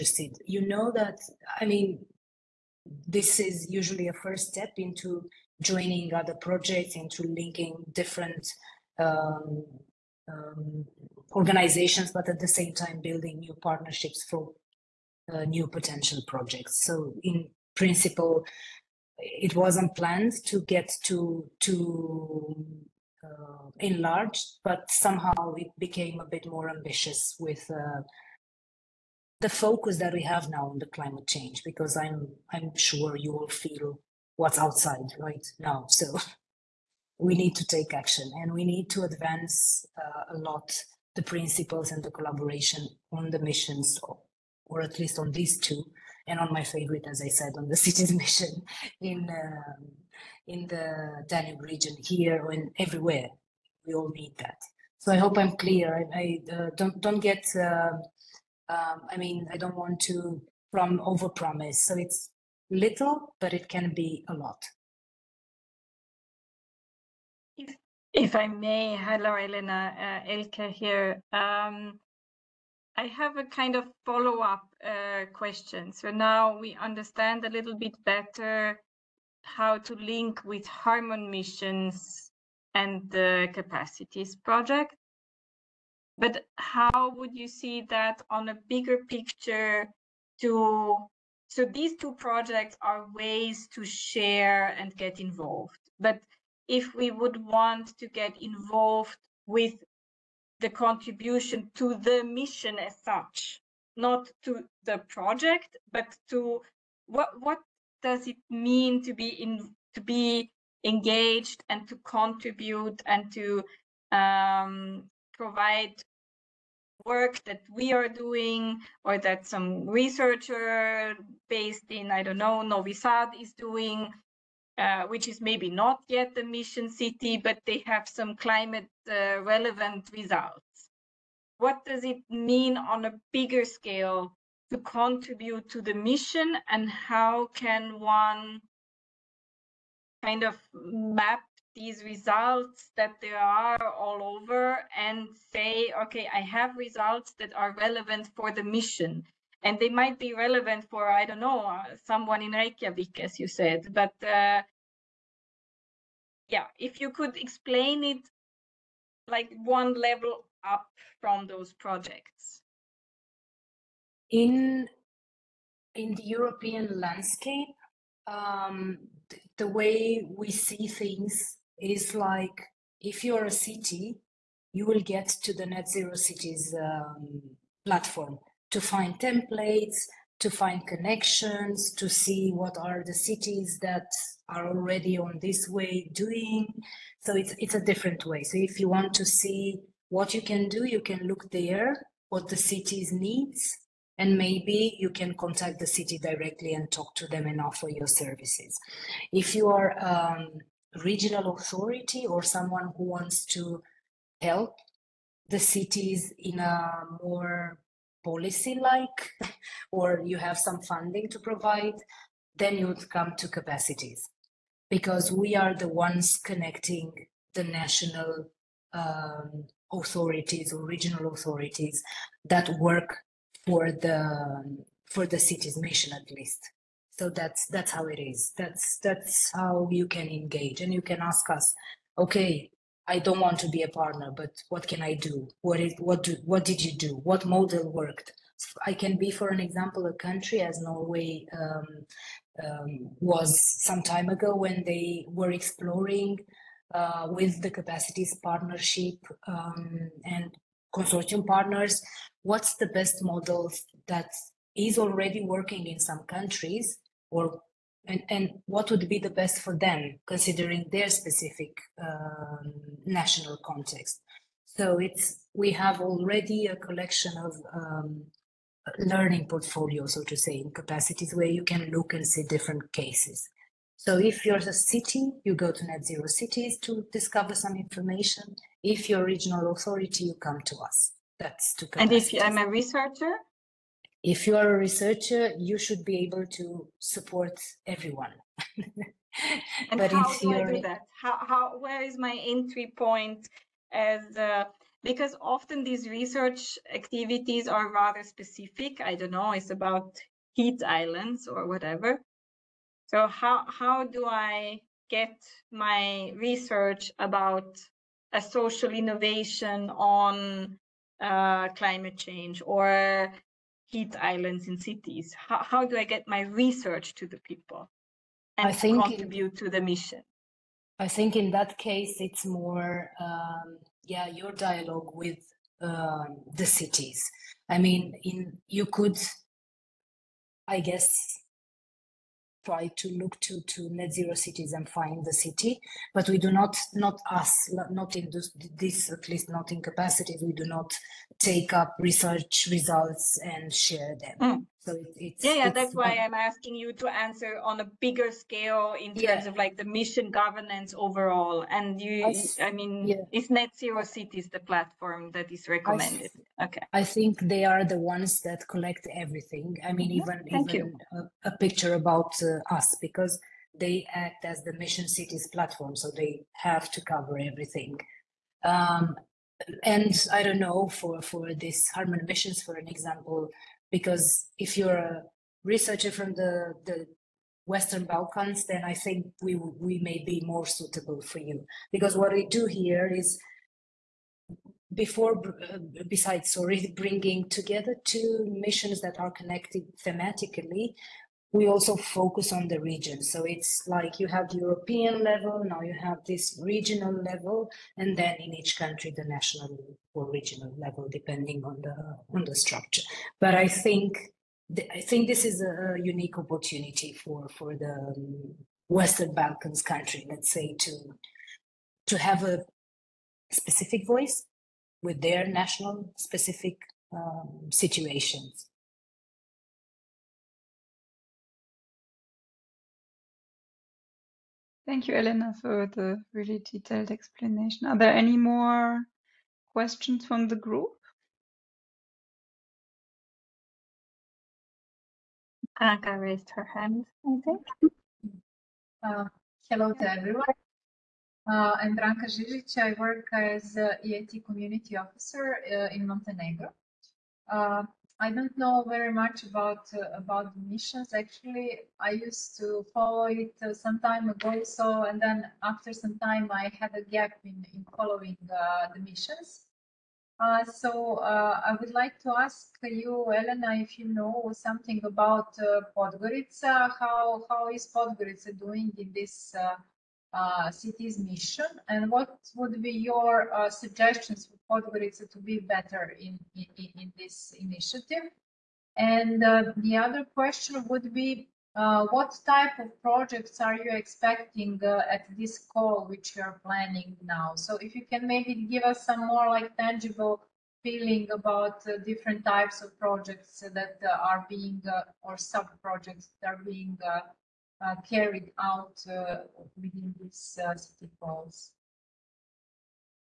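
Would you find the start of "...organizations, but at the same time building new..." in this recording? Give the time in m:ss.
0:11.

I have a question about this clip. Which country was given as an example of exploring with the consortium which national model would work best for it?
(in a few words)
Norway.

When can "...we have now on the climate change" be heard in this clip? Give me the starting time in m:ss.
0:30.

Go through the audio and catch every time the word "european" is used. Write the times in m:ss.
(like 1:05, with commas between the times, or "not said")
2:46, 6:34.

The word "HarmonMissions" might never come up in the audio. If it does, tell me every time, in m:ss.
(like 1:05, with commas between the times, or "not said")
1:20, 6:11.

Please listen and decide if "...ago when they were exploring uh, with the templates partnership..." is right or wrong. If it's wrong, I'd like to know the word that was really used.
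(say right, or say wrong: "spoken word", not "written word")
wrong: "capacities", not "templates".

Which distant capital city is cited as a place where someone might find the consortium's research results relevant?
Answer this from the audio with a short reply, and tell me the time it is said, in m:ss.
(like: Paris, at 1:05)
Reykjavik, at 2:32.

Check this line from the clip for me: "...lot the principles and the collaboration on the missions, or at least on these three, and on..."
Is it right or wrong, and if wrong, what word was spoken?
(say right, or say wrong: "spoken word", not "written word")
wrong: "two", not "three".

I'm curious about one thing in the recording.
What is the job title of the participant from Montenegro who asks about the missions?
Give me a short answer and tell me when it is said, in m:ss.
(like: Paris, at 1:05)
EIT Community Officer, at 7:23.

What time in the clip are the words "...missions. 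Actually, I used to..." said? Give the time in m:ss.
7:30.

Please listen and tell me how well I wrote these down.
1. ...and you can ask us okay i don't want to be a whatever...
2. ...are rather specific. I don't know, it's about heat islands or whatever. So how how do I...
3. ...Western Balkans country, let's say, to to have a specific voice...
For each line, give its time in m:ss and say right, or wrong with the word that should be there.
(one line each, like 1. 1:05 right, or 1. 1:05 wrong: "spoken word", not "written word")
1. 3:50 wrong: "partner", not "whatever"
2. 4:57 right
3. 6:48 right.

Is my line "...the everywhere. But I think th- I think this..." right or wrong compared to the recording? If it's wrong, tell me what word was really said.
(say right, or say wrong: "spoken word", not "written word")
wrong: "structure", not "everywhere".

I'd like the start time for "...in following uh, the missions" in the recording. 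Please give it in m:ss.
7:37.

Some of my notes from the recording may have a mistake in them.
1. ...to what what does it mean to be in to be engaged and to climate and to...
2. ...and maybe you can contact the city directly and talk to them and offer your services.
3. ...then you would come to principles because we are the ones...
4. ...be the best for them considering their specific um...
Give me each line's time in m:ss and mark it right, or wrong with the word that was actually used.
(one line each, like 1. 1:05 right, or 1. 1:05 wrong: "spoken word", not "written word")
1. 1:46 wrong: "contribute", not "climate"
2. 3:14 right
3. 3:32 wrong: "capacities", not "principles"
4. 4:19 right.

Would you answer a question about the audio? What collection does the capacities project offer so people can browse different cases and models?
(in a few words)
learning portfolio.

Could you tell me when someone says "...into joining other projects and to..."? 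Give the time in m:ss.
0:04.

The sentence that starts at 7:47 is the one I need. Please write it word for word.
How how is Podgorica doing in this?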